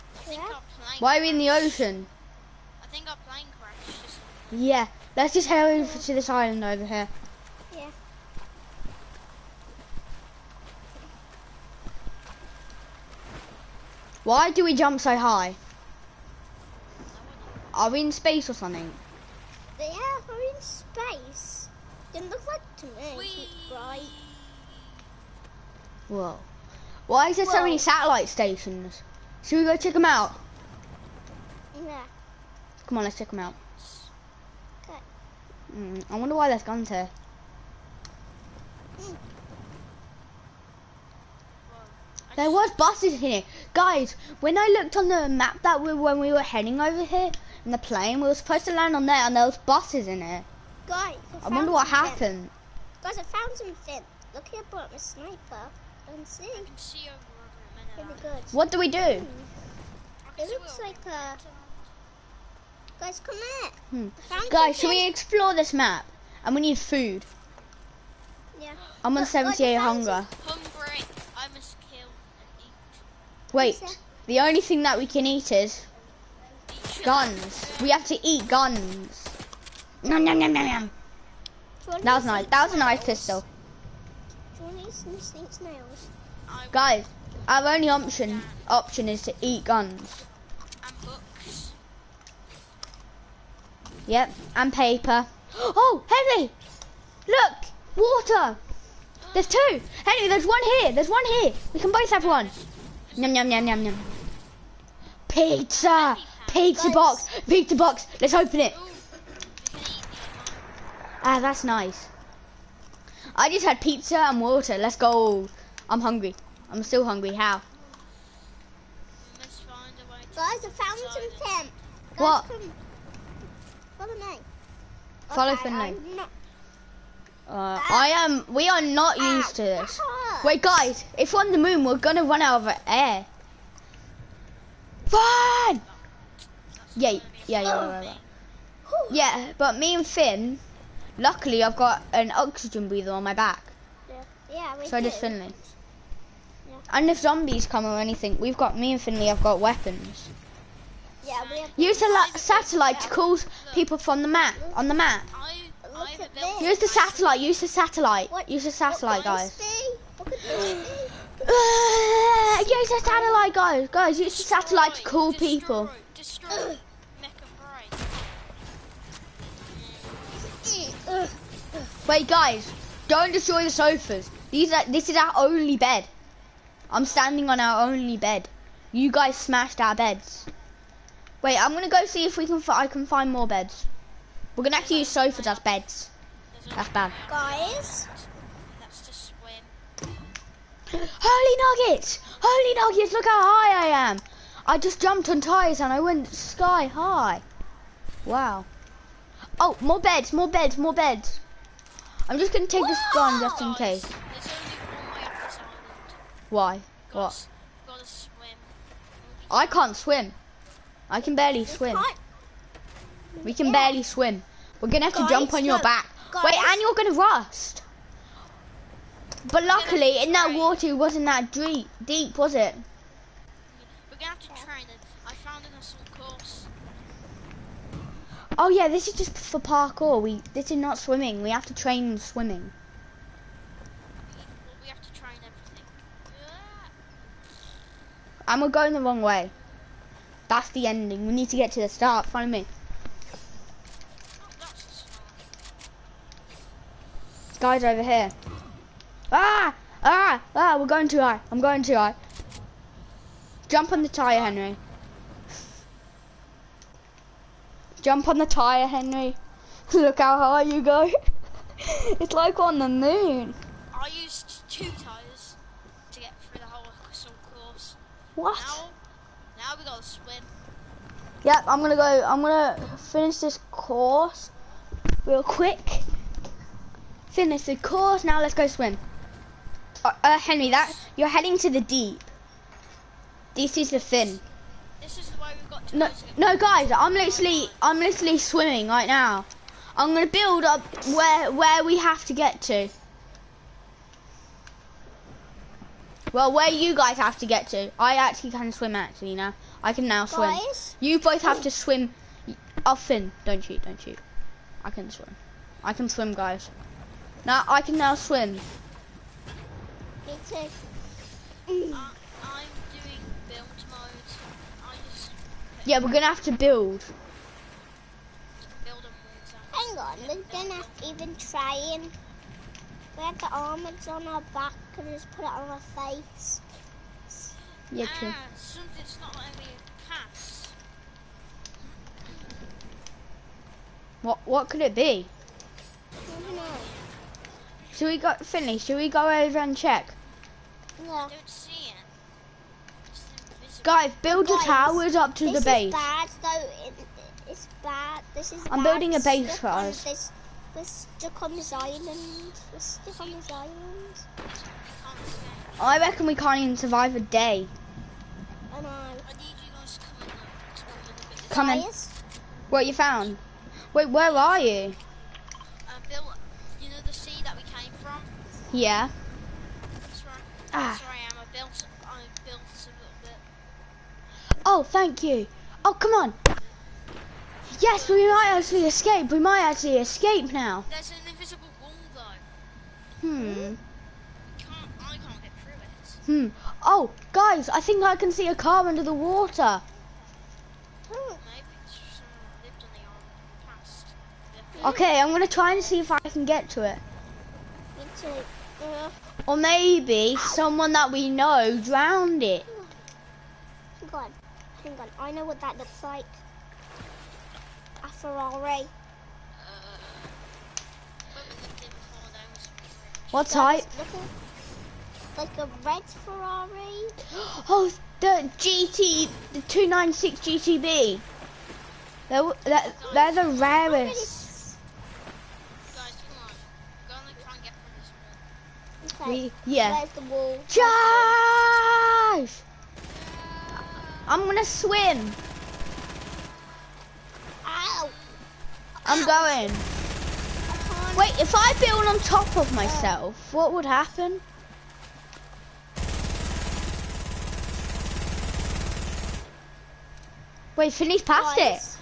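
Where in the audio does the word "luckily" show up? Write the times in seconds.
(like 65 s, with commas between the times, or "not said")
141 s, 219 s.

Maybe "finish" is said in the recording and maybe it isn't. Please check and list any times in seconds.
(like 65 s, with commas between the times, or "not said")
272 s, 277 s.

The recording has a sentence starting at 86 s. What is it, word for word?
Guys, our only option option is to eat guns.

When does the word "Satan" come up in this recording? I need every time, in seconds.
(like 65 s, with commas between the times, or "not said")
not said.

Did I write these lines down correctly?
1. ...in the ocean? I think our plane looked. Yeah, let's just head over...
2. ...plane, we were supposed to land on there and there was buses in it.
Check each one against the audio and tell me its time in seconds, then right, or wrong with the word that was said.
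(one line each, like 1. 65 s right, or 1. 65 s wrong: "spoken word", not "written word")
1. 1 s wrong: "crashed", not "looked"
2. 47 s right.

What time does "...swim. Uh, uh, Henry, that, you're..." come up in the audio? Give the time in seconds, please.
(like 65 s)
278 s.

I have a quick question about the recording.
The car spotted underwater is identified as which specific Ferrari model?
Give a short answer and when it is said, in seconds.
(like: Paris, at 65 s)
296 GTB, at 419 s.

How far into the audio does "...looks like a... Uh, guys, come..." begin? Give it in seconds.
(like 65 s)
60 s.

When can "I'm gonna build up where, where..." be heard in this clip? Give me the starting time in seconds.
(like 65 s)
289 s.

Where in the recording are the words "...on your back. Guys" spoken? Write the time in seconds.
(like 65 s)
215 s.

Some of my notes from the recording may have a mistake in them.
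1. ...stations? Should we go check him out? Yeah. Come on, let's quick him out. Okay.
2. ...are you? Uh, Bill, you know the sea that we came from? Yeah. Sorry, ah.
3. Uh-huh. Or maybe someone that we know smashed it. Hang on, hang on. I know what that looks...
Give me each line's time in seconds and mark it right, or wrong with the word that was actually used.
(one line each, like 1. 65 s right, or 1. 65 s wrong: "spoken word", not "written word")
1. 28 s wrong: "check", not "quick"
2. 364 s right
3. 398 s wrong: "drowned", not "smashed".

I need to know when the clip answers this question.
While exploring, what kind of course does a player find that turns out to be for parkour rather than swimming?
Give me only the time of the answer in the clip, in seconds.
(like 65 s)
225 s.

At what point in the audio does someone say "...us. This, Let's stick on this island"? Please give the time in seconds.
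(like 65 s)
349 s.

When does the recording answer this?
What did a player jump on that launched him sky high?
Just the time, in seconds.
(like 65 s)
195 s.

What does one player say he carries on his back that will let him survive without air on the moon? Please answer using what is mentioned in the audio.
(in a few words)
An oxygen breather.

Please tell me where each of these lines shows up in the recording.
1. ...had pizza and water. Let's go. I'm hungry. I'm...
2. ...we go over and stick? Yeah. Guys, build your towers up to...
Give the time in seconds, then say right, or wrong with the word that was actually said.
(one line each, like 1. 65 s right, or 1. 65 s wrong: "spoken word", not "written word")
1. 113 s right
2. 338 s wrong: "check", not "stick".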